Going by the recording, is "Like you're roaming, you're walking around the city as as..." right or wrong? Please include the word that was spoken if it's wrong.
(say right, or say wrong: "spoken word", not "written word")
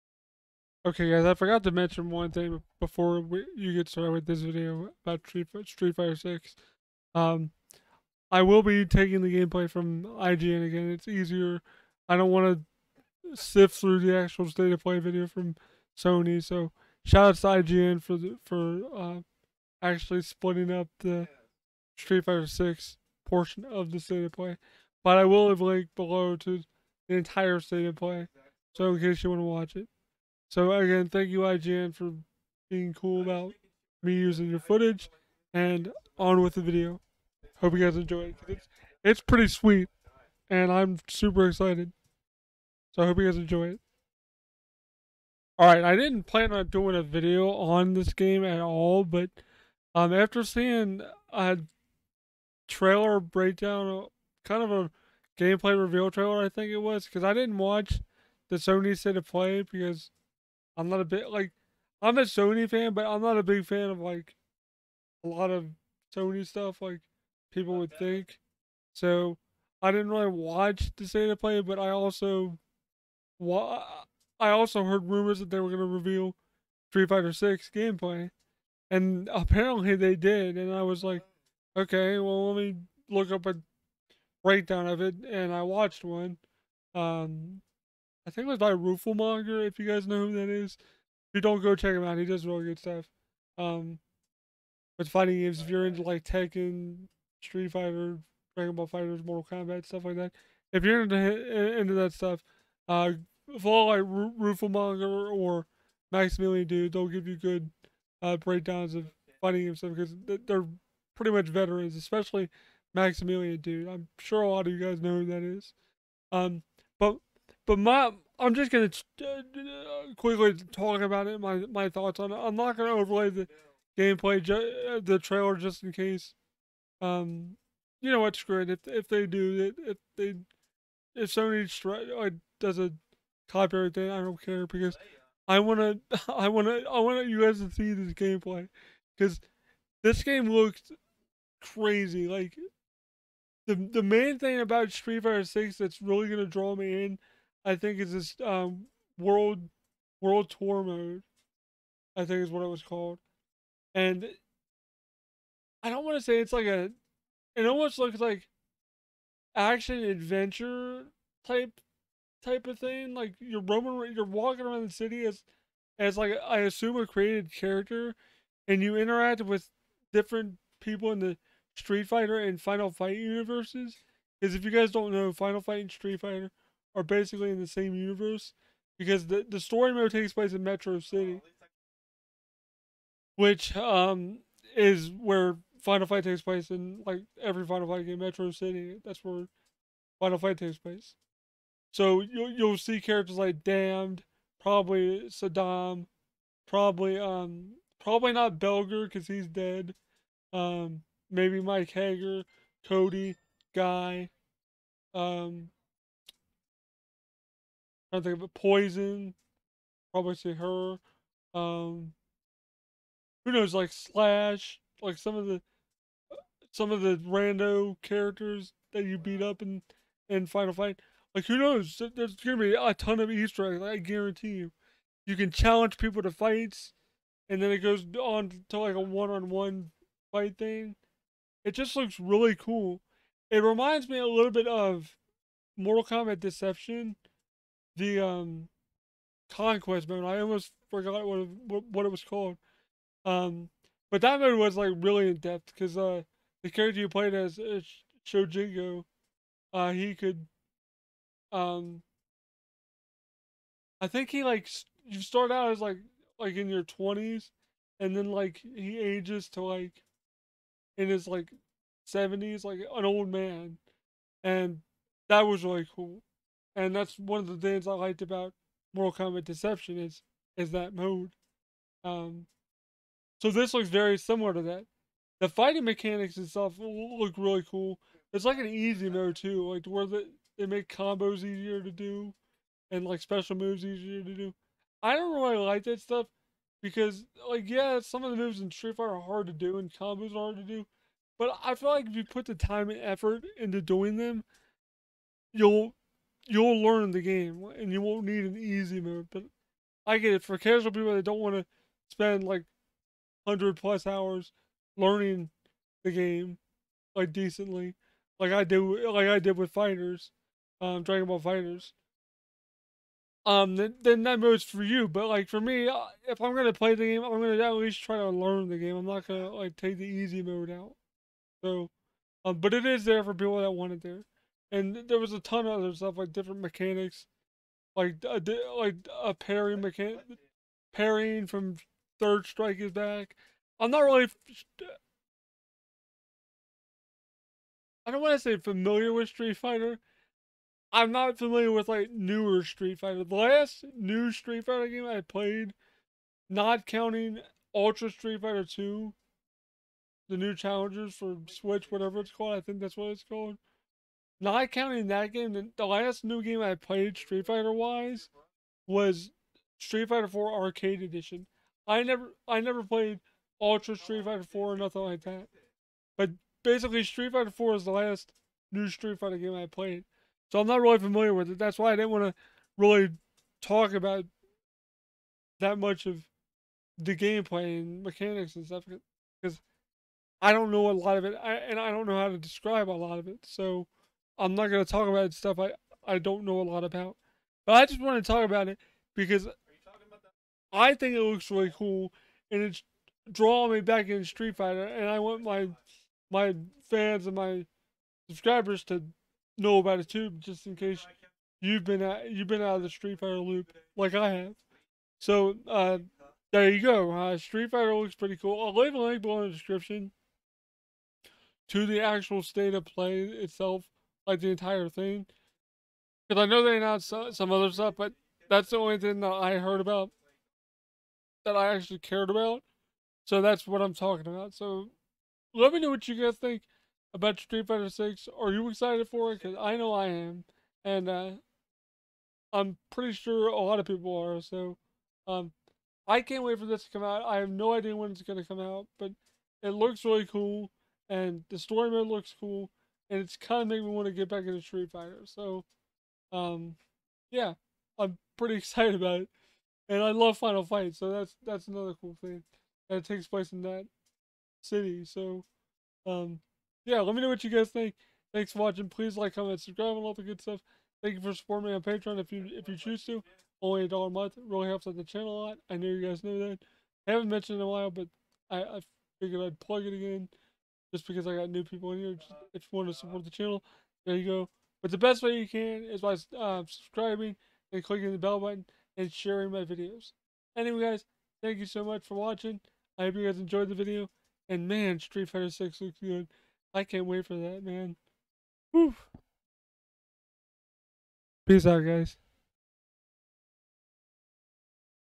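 right.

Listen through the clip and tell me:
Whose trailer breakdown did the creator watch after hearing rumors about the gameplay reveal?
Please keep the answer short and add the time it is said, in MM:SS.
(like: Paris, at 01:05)
Rooflemonger, at 01:28.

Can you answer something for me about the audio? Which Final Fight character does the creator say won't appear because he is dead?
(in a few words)
Belger.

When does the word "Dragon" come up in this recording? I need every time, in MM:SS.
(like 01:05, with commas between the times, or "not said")
01:38, 05:11.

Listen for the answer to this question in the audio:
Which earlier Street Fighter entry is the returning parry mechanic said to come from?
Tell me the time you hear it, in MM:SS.
05:32.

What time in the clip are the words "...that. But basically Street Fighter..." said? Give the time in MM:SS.
06:05.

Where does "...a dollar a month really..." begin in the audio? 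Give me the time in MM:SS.
07:43.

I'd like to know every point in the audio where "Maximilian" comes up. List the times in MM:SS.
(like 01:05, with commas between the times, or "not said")
01:46, 01:52.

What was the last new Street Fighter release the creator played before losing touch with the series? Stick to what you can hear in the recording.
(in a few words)
Street Fighter 4 Arcade Edition.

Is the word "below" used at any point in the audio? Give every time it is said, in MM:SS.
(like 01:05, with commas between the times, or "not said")
00:25, 06:49.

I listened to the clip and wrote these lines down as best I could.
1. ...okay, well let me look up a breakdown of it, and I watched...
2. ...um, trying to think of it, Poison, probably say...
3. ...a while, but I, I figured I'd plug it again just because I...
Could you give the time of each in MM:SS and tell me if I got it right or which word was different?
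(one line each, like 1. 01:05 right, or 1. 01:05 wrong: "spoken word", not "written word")
1. 01:21 right
2. 03:25 right
3. 07:47 right.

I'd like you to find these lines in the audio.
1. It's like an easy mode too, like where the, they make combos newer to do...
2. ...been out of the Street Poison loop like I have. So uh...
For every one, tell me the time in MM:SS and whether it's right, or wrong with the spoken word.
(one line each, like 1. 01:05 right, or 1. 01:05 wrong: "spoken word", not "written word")
1. 04:38 wrong: "easier", not "newer"
2. 06:42 wrong: "Fighter", not "Poison".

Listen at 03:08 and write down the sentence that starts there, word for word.
Metro City, that's where Final Fight takes place.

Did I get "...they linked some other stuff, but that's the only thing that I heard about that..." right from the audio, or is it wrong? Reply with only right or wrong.
wrong.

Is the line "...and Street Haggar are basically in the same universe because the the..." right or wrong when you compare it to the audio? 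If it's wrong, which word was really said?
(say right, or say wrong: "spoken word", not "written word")
wrong: "Fighter", not "Haggar".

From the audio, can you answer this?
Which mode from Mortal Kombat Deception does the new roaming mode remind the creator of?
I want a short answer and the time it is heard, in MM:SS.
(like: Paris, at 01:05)
Conquest mode, at 03:59.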